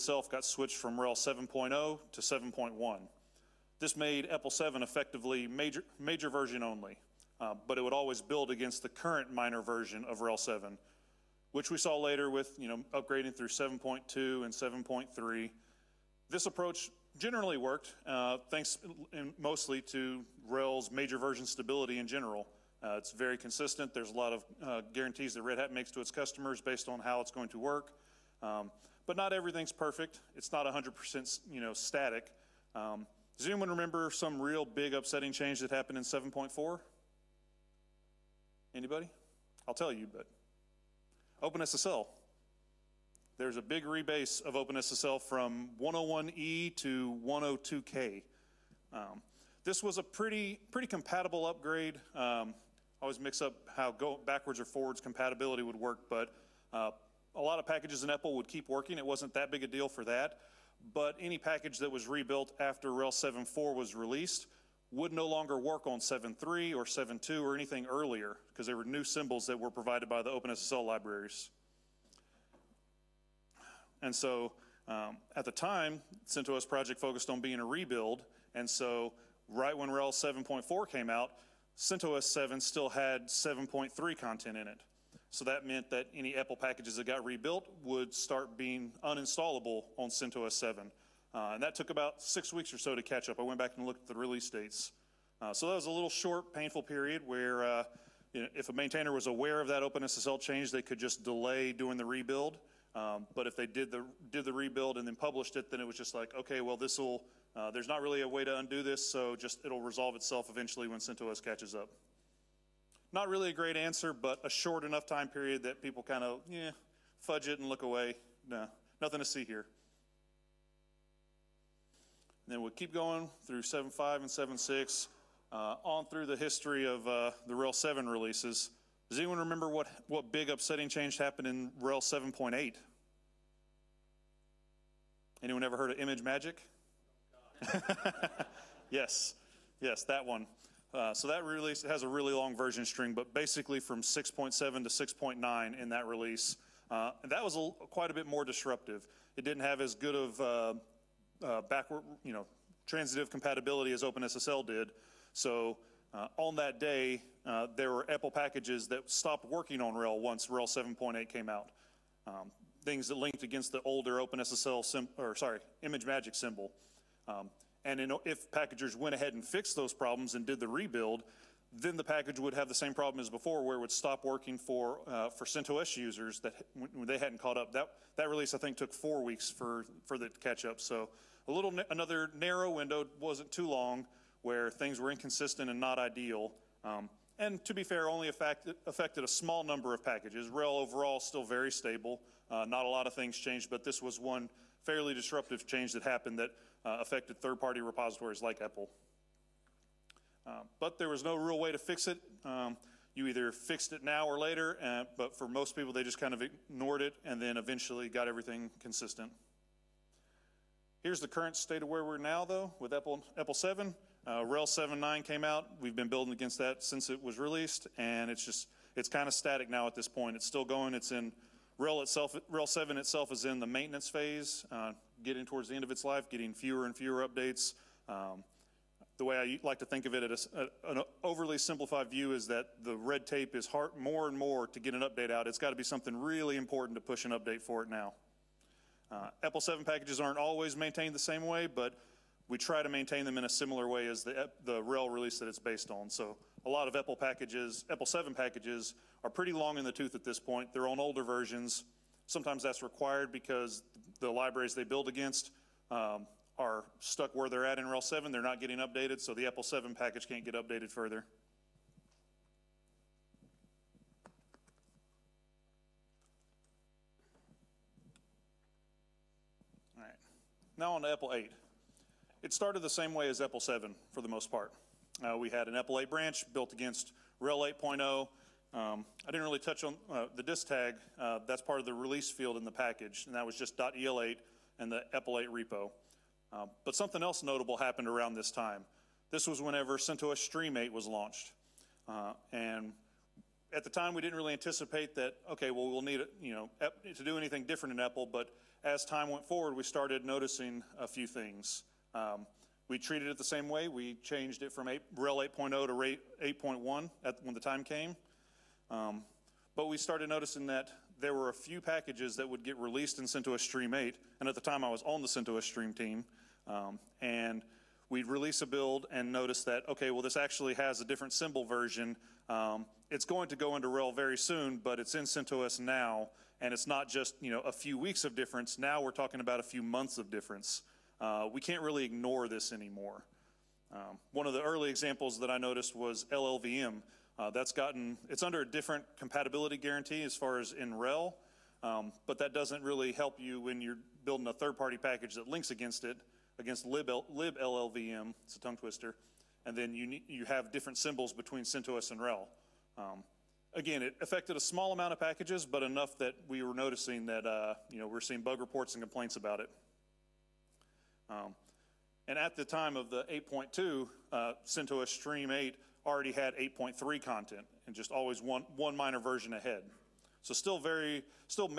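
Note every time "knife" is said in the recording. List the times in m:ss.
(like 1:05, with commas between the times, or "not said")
not said.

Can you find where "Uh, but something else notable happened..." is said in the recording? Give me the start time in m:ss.
4:46.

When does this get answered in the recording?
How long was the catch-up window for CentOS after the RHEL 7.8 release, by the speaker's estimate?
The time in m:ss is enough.
2:58.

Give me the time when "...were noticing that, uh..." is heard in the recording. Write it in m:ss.
5:56.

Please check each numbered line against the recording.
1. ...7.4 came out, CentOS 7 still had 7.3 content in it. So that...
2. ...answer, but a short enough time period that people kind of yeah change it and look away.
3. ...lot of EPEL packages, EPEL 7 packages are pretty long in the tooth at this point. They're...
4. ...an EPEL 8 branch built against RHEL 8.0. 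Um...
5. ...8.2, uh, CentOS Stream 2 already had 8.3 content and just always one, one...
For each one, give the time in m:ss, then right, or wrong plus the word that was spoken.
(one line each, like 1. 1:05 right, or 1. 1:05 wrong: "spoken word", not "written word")
1. 1:20 right
2. 1:53 wrong: "fudge", not "change"
3. 4:06 right
4. 4:35 right
5. 6:03 wrong: "8", not "2".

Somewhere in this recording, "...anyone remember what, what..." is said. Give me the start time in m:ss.
2:09.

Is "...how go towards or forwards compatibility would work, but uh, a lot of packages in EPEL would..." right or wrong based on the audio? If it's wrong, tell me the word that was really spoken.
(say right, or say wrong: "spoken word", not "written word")
wrong: "backwards", not "towards".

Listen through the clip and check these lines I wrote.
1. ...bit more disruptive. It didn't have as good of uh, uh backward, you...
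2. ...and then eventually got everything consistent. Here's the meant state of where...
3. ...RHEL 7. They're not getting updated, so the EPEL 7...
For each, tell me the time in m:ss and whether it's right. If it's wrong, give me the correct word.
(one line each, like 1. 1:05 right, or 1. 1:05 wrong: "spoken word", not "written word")
1. 2:28 right
2. 3:27 wrong: "current", not "meant"
3. 4:17 right.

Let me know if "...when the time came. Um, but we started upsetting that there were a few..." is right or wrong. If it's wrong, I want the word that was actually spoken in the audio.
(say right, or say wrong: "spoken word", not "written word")
wrong: "noticing", not "upsetting".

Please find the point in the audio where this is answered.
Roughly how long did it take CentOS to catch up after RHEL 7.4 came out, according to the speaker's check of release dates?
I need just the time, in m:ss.
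1:32.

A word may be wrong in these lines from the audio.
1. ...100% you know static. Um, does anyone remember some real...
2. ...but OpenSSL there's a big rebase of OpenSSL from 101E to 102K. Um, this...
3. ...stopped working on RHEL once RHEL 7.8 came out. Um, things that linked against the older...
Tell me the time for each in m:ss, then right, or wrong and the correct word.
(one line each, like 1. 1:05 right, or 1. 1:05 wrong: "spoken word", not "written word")
1. 0:30 right
2. 0:40 right
3. 2:39 right.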